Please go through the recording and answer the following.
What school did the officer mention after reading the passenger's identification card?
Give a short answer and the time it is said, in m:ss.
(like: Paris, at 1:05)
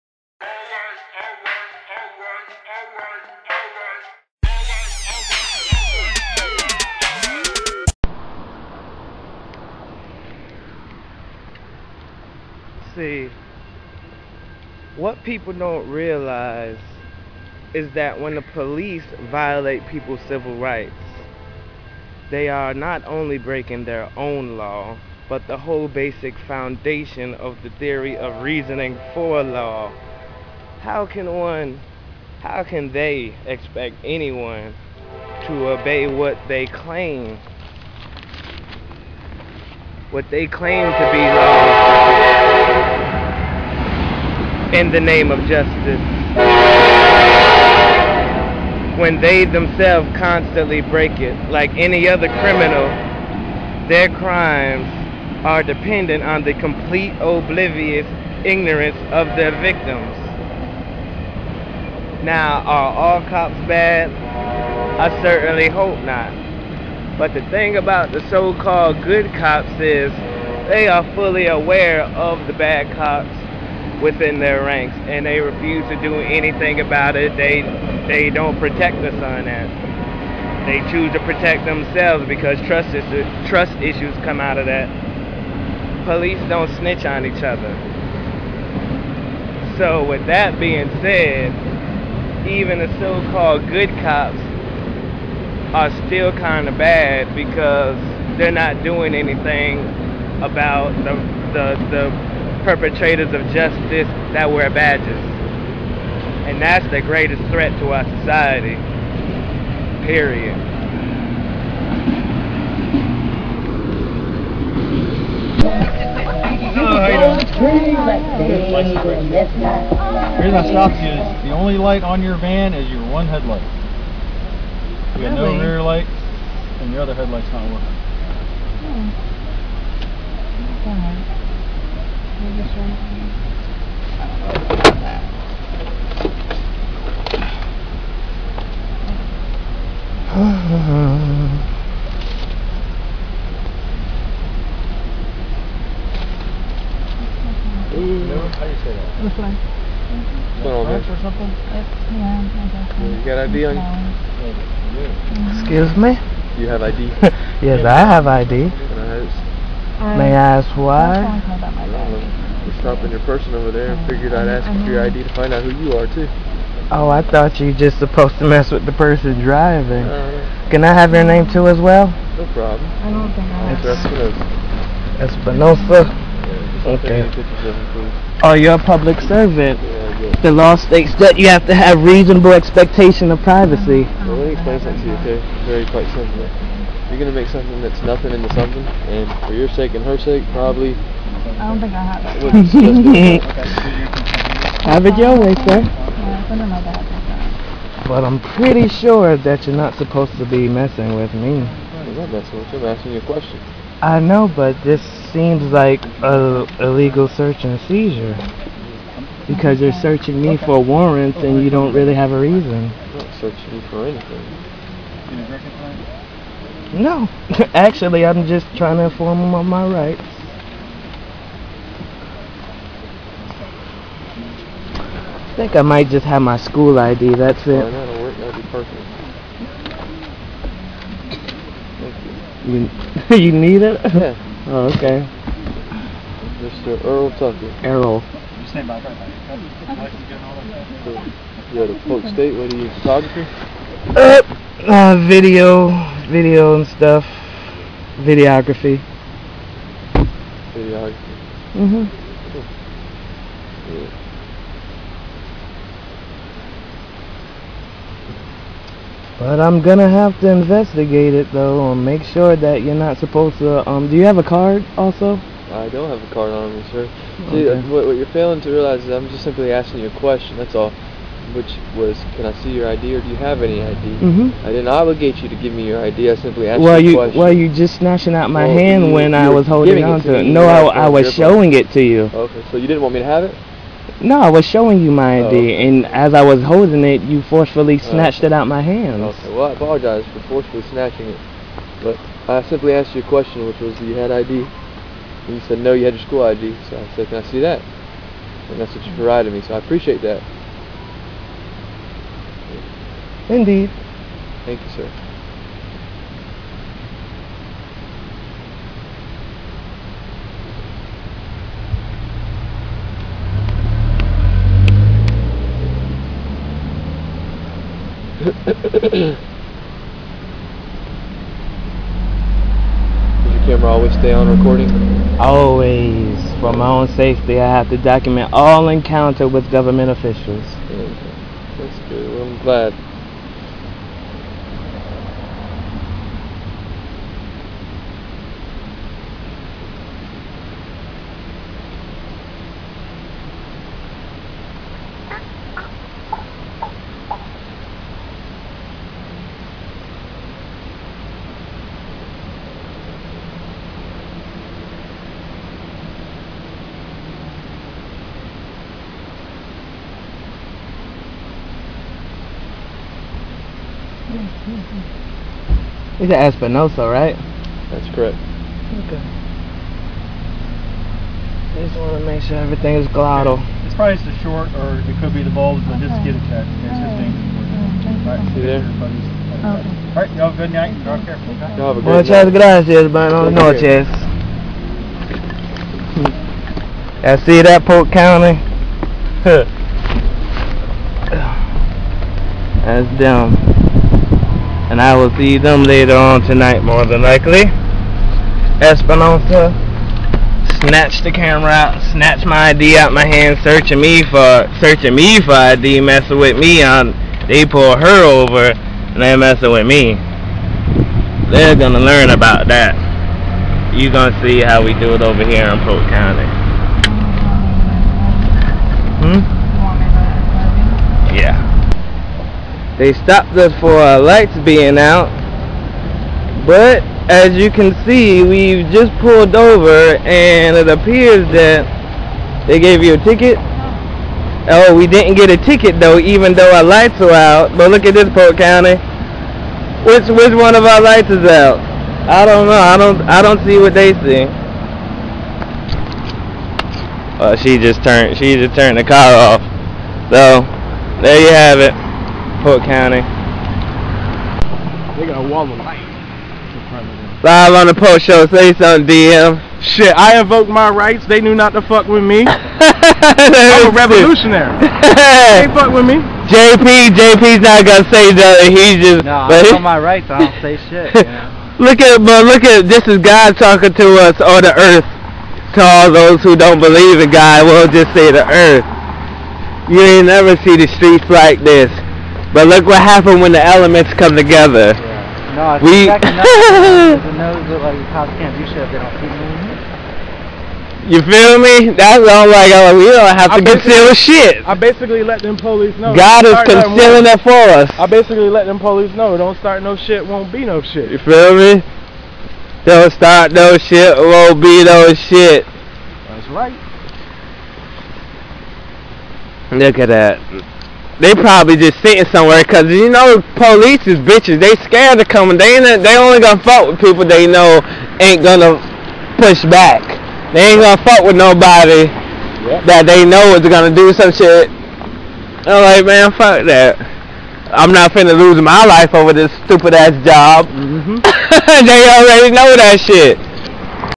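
Polk State, at 4:02.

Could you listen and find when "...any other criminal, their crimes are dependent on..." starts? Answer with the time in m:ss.
0:51.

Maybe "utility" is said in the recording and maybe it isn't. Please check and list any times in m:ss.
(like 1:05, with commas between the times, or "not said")
not said.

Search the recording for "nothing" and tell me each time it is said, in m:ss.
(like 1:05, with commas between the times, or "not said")
3:08, 7:48.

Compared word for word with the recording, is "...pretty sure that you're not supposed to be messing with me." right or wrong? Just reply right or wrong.
right.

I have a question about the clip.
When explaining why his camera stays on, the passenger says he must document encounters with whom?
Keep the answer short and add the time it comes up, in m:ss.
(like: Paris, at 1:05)
Government officials, at 5:29.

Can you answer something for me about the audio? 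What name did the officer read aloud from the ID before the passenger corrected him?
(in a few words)
Earl Tucker.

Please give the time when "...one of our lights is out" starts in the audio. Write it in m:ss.
7:20.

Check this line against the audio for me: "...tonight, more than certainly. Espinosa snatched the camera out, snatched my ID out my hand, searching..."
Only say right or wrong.
wrong.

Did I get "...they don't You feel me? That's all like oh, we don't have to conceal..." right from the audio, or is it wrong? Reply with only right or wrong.
right.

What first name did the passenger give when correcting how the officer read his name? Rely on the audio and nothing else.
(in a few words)
Errol.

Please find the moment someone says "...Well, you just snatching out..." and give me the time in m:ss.
4:37.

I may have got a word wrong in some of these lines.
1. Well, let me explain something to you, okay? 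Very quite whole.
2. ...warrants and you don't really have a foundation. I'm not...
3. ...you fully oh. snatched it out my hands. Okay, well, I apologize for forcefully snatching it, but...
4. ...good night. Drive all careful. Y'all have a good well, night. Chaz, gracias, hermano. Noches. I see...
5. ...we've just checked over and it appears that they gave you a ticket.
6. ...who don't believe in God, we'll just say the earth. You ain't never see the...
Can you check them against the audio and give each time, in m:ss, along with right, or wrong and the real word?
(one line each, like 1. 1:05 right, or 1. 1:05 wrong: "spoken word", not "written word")
1. 3:04 wrong: "simple", not "whole"
2. 3:30 wrong: "reason", not "foundation"
3. 4:47 wrong: "forcefully", not "fully"
4. 6:20 right
5. 7:08 wrong: "pulled", not "checked"
6. 7:56 right.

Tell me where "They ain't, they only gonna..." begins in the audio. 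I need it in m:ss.
8:35.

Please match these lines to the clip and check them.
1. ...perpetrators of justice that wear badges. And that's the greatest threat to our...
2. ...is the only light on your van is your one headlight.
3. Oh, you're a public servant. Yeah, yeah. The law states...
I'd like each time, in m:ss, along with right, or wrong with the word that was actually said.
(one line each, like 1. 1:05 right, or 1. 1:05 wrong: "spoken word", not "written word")
1. 1:42 right
2. 2:01 right
3. 2:58 right.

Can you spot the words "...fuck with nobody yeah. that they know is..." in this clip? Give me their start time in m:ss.
8:41.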